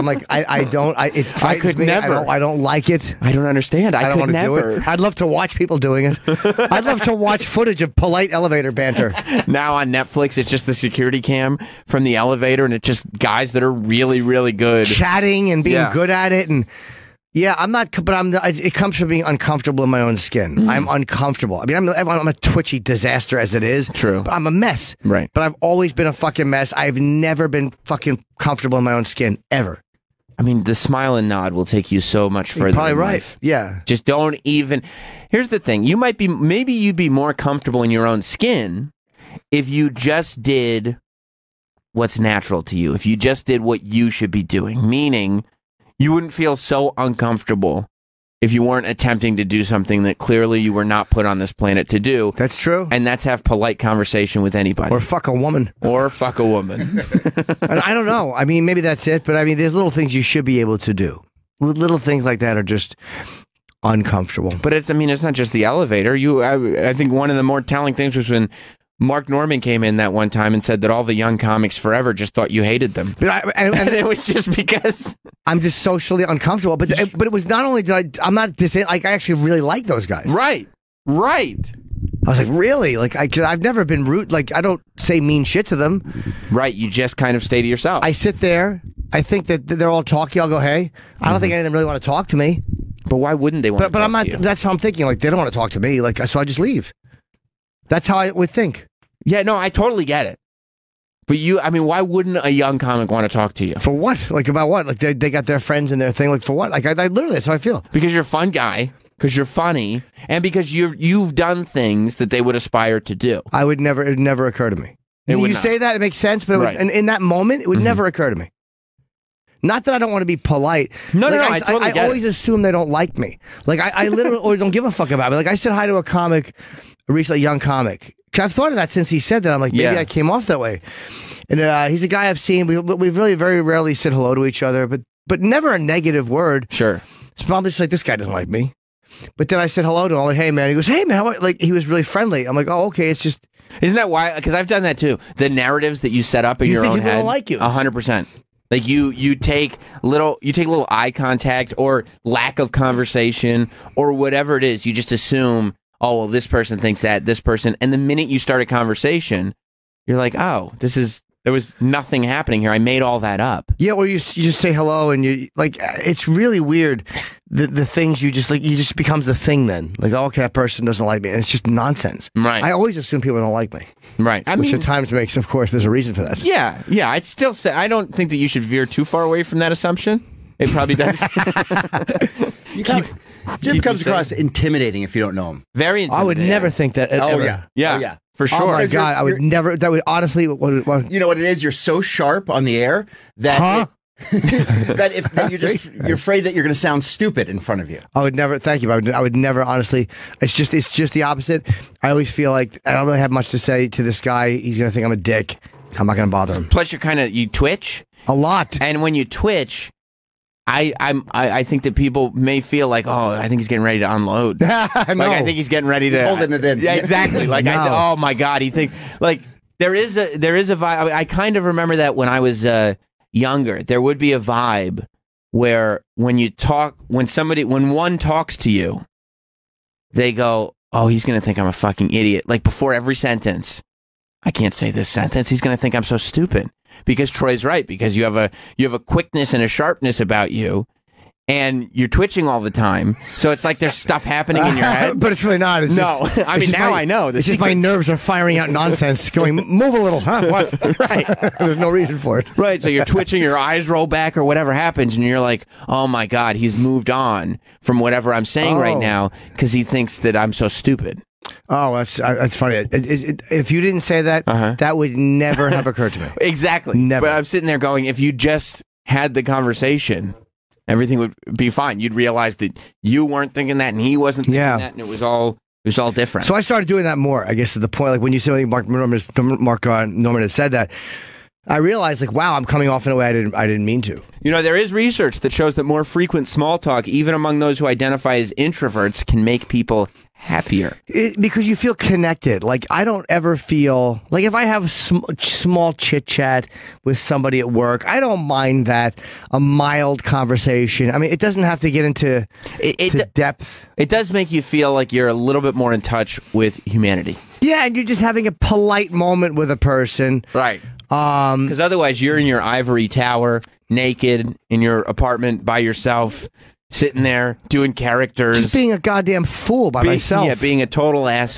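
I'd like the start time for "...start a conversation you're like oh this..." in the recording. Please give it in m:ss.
2:38.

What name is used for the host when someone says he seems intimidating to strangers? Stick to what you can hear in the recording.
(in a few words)
Jim.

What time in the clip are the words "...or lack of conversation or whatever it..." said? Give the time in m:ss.
2:31.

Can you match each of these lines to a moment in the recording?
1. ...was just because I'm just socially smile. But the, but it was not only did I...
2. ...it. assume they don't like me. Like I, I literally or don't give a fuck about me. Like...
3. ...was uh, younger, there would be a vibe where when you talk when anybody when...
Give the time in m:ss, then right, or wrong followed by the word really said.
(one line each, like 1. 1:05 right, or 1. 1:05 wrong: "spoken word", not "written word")
1. 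1:14 wrong: "uncomfortable", not "smile"
2. 2:02 right
3. 3:42 wrong: "somebody", not "anybody".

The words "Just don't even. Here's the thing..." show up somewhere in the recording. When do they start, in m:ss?
0:33.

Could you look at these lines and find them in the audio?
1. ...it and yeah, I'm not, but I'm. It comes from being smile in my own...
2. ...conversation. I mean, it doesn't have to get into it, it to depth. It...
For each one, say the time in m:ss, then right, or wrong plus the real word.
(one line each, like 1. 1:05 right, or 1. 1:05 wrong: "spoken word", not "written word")
1. 0:16 wrong: "uncomfortable", not "smile"
2. 5:00 right.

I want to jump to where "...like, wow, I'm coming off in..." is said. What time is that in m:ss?
4:42.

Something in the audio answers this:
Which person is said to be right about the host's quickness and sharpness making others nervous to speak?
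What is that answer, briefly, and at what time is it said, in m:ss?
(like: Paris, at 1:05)
Troy, at 3:57.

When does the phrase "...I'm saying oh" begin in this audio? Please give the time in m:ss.
4:18.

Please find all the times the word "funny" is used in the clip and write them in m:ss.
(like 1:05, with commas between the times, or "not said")
1:49, 4:22.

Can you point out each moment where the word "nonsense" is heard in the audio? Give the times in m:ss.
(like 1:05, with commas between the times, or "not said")
2:51, 4:08.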